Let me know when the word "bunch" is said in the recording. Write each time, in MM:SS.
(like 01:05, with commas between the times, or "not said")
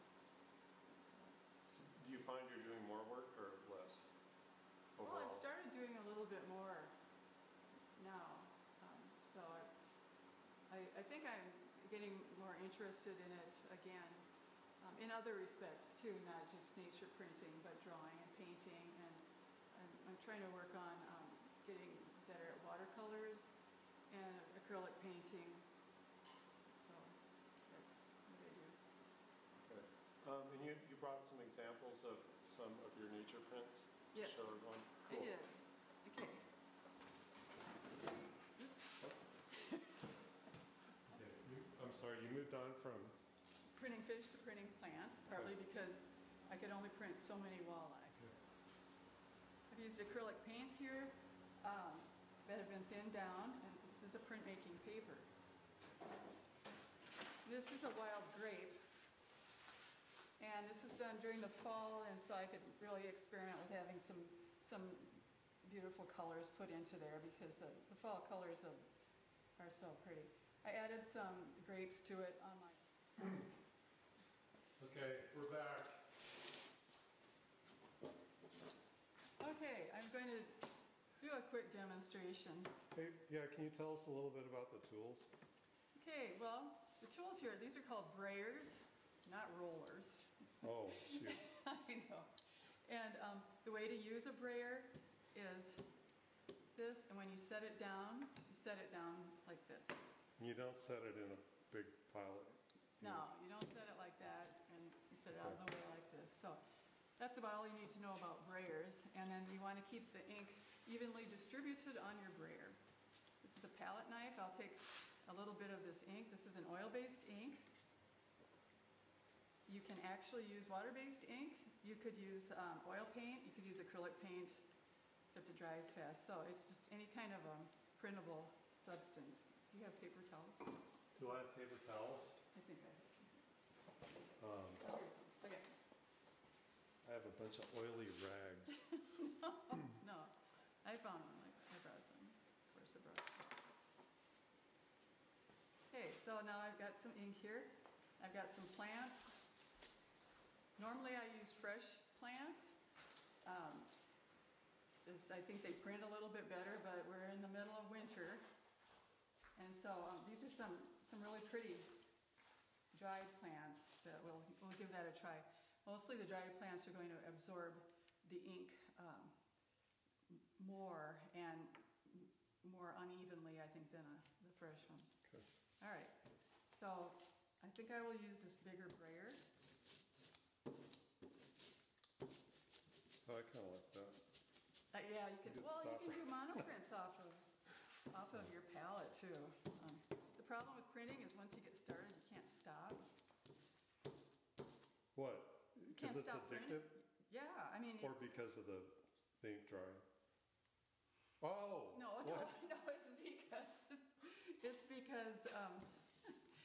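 02:17.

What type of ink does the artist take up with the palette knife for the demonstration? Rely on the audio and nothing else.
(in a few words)
oil-based ink.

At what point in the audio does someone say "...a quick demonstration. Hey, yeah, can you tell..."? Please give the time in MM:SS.
01:21.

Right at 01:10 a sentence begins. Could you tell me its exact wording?
I added some grapes to it on my...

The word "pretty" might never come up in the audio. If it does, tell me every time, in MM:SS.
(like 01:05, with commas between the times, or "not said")
01:10, 02:41.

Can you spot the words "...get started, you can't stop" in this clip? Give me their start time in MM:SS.
03:11.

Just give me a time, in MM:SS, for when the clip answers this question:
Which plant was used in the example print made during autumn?
00:57.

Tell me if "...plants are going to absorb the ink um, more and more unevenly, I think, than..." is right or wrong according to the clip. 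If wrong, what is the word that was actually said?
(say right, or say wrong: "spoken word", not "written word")
right.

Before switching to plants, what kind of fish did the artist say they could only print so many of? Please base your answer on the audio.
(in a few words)
walleye.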